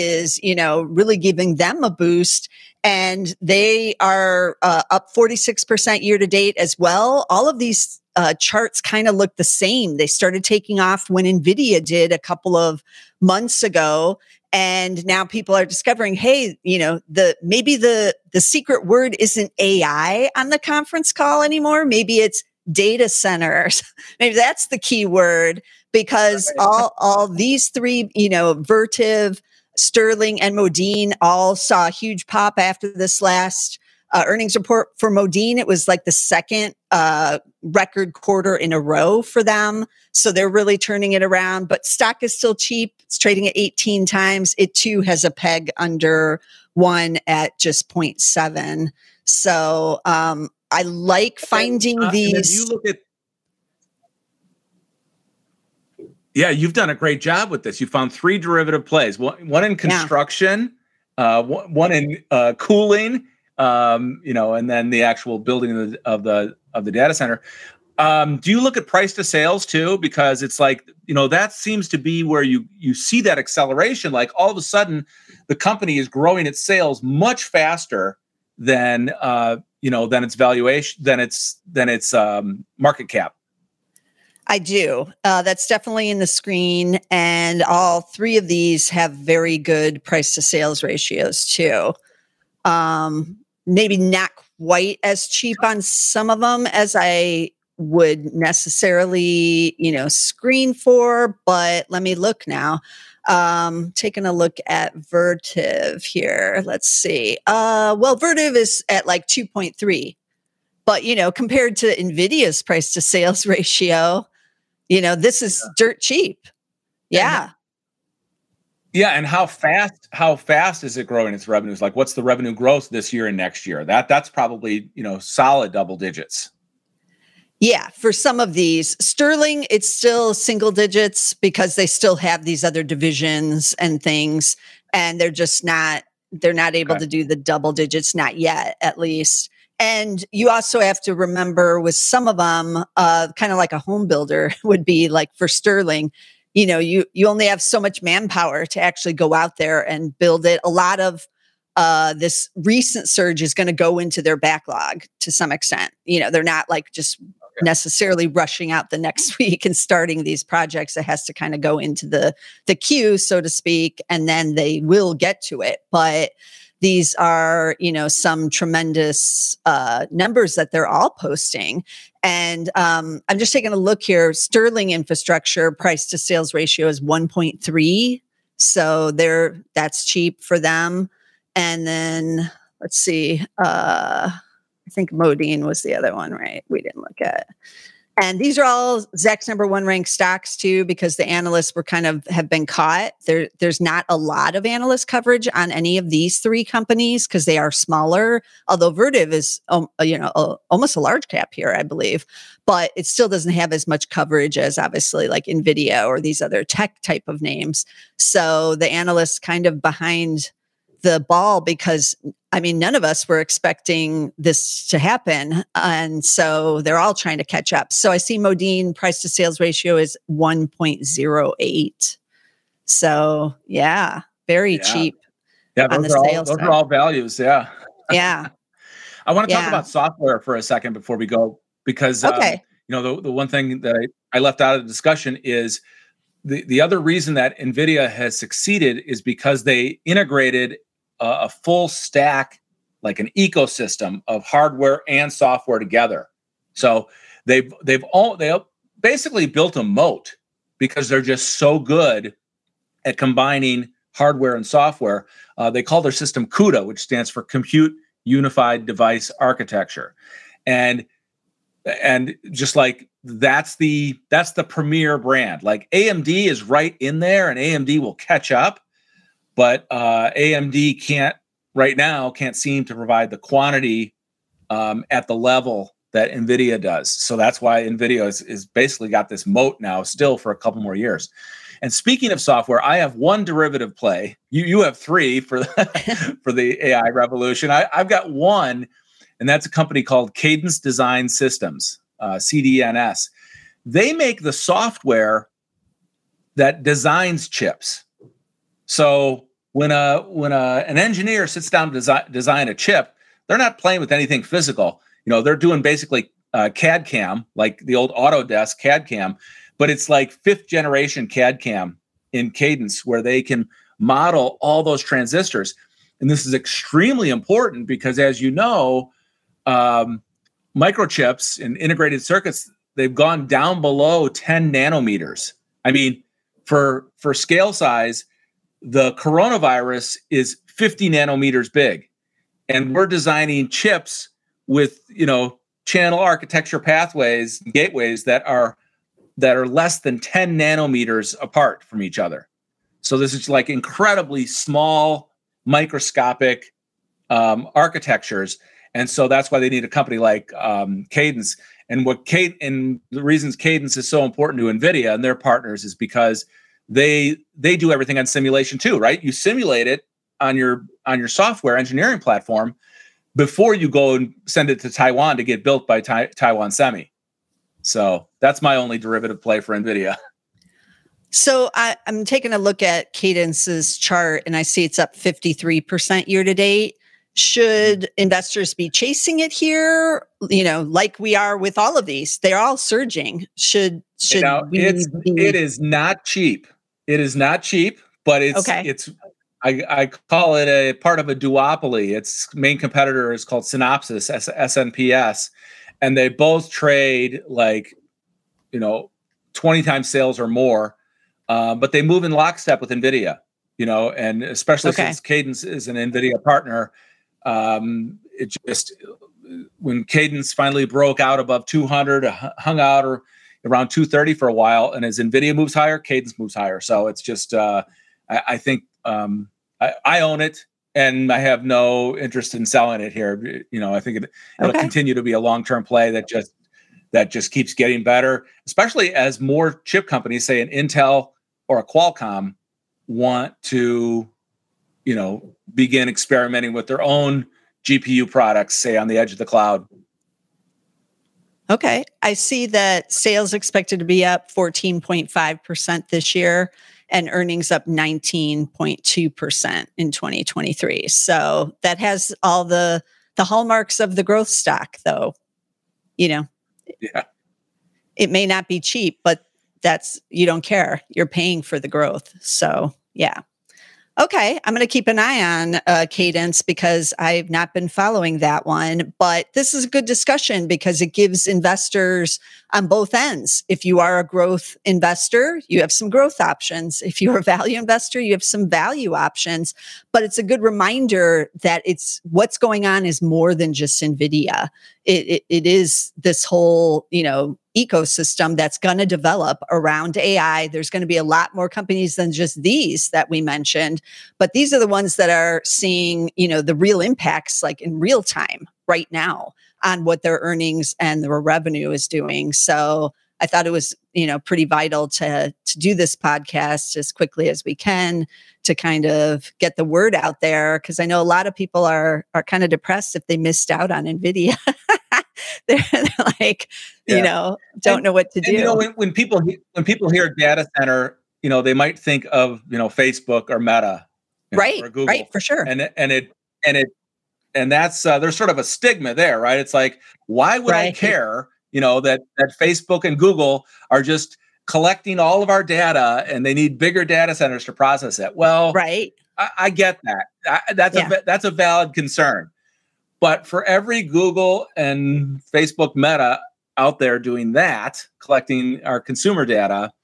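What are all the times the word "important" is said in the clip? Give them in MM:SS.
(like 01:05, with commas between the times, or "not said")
05:17, 05:54.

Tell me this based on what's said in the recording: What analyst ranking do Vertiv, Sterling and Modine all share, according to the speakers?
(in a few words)
Zacks number one.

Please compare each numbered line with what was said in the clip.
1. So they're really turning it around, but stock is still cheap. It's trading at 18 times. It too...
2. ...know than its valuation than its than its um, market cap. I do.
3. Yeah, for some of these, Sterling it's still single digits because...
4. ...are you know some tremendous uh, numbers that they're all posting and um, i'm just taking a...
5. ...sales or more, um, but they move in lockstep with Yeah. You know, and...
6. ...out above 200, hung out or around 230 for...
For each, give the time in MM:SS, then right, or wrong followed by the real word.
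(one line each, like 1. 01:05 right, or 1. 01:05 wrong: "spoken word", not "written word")
1. 00:40 right
2. 01:19 right
3. 02:07 right
4. 02:47 right
5. 06:40 wrong: "NVIDIA", not "Yeah"
6. 06:51 right.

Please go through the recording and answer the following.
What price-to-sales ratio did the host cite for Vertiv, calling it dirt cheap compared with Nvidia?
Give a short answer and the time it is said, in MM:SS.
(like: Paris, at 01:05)
2.3, at 01:49.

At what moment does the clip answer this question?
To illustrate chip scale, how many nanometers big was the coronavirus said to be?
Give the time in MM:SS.
05:30.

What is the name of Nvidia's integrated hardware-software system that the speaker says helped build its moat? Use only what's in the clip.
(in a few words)
CUDA.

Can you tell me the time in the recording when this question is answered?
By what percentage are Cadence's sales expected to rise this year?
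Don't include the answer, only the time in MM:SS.
07:24.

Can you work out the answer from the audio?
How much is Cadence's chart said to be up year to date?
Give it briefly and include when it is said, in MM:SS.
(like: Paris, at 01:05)
53%, at 06:15.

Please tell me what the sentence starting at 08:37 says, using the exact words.
you know, don't and, know what to do.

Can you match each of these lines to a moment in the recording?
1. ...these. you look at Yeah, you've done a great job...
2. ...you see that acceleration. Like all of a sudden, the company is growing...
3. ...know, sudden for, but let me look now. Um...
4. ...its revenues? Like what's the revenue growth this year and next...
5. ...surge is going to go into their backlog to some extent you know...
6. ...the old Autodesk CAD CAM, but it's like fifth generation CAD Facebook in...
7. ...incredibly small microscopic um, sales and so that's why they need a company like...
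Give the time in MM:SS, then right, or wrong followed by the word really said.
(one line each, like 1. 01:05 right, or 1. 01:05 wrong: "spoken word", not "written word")
1. 00:52 right
2. 01:12 right
3. 01:39 wrong: "screen", not "sudden"
4. 02:01 right
5. 02:33 right
6. 05:07 wrong: "CAM", not "Facebook"
7. 05:43 wrong: "architectures", not "sales".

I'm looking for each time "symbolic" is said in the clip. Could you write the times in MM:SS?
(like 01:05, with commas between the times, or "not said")
not said.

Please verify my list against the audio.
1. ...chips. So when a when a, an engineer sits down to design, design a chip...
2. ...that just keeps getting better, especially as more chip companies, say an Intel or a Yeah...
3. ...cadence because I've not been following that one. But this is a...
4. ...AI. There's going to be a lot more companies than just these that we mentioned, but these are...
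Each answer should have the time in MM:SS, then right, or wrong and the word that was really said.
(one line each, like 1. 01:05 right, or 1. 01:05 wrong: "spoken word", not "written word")
1. 04:57 right
2. 07:07 wrong: "Qualcomm", not "Yeah"
3. 07:46 right
4. 08:10 right.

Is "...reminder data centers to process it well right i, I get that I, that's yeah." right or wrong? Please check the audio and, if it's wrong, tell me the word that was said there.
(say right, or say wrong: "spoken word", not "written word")
wrong: "bigger", not "reminder".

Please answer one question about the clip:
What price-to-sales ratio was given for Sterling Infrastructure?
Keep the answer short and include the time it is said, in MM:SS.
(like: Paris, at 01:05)
1.3, at 02:57.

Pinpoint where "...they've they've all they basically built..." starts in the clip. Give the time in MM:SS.
04:07.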